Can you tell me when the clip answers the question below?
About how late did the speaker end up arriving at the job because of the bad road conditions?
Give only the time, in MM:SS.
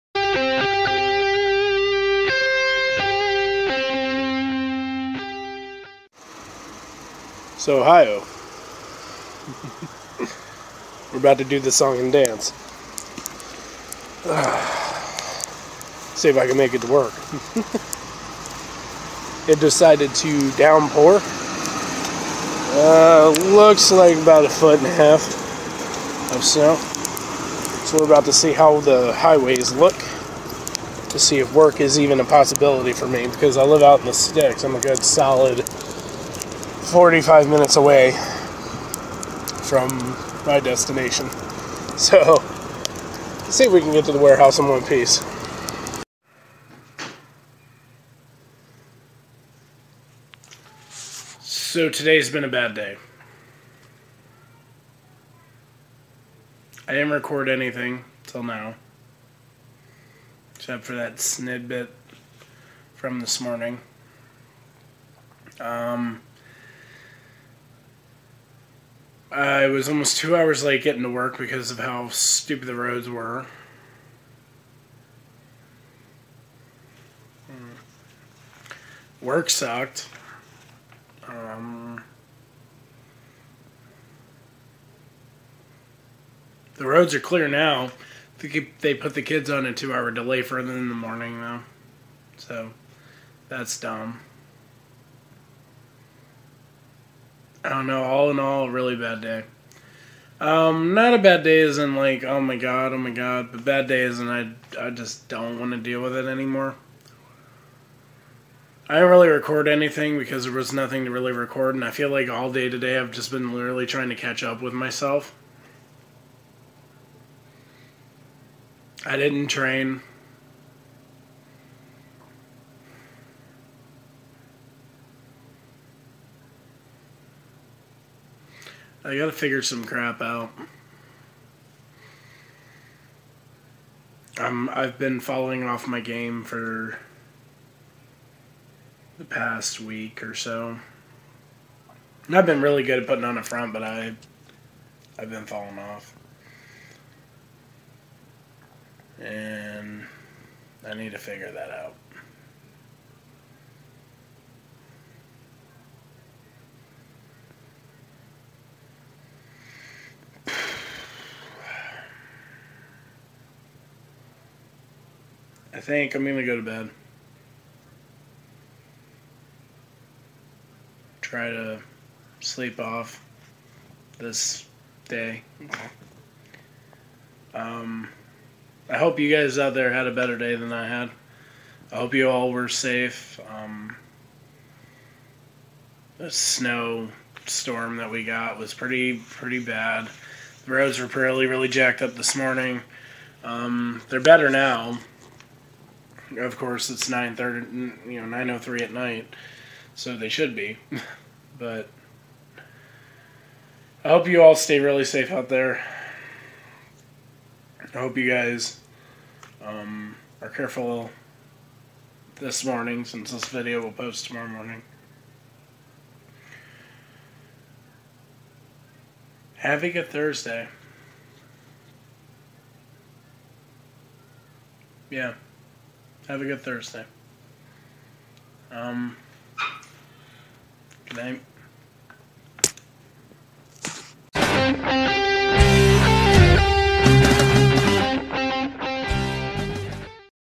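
01:09.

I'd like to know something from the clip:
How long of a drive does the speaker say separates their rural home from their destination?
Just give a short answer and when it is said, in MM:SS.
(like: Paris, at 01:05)
45 minutes, at 00:36.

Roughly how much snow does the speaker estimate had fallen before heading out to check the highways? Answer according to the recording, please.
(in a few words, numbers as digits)
a foot and a half.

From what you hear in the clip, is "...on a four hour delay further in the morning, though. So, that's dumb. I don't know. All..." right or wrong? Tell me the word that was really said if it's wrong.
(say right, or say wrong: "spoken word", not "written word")
wrong: "two", not "four".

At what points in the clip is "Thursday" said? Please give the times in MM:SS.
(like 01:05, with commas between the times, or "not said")
03:40, 03:46.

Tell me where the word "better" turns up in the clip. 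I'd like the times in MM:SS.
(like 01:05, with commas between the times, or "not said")
03:00, 03:14.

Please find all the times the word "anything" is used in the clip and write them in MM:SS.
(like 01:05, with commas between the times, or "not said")
00:57, 01:49.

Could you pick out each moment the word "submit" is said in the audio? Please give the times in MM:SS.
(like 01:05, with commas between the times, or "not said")
not said.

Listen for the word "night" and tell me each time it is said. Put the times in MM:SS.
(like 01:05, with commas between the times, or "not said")
03:18, 03:51.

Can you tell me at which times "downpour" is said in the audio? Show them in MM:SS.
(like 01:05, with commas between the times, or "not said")
00:20.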